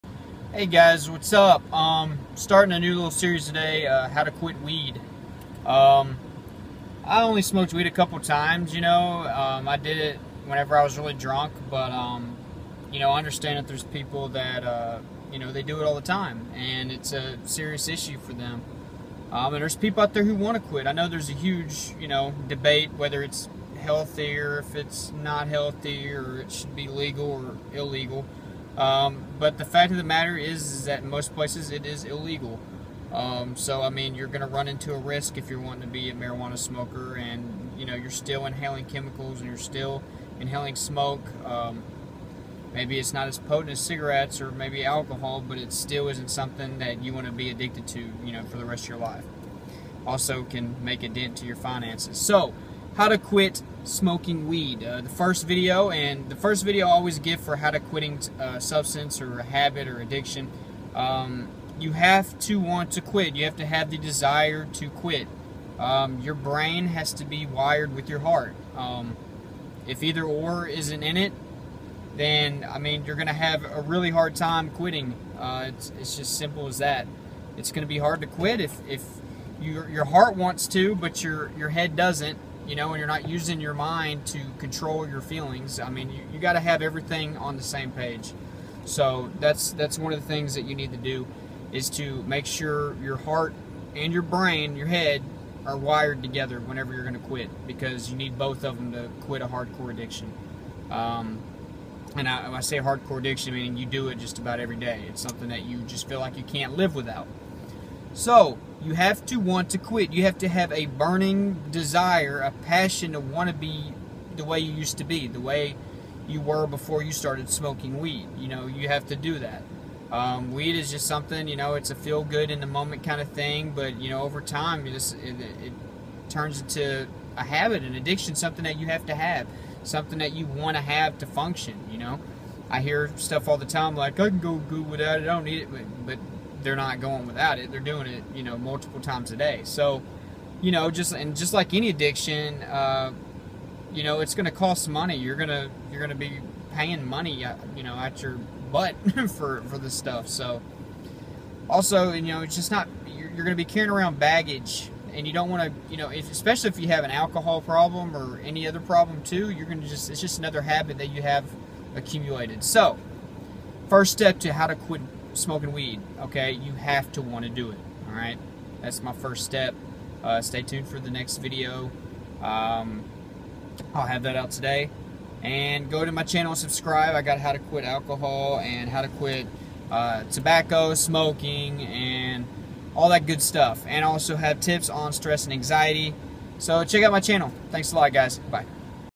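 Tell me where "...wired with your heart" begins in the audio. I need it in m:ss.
1:07.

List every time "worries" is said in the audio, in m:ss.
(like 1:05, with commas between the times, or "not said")
not said.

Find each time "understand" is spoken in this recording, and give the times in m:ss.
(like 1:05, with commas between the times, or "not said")
0:13.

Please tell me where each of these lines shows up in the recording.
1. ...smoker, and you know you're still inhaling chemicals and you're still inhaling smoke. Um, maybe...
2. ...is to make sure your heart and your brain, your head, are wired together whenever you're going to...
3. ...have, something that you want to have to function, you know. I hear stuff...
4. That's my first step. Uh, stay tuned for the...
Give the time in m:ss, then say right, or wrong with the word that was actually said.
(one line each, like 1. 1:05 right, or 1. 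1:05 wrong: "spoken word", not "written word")
1. 0:36 right
2. 1:31 right
3. 2:09 right
4. 2:48 right.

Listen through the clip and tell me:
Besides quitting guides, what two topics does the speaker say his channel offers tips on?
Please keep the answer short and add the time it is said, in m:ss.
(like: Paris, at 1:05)
Stress and anxiety, at 3:05.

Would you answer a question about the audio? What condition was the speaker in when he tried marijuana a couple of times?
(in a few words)
Really drunk.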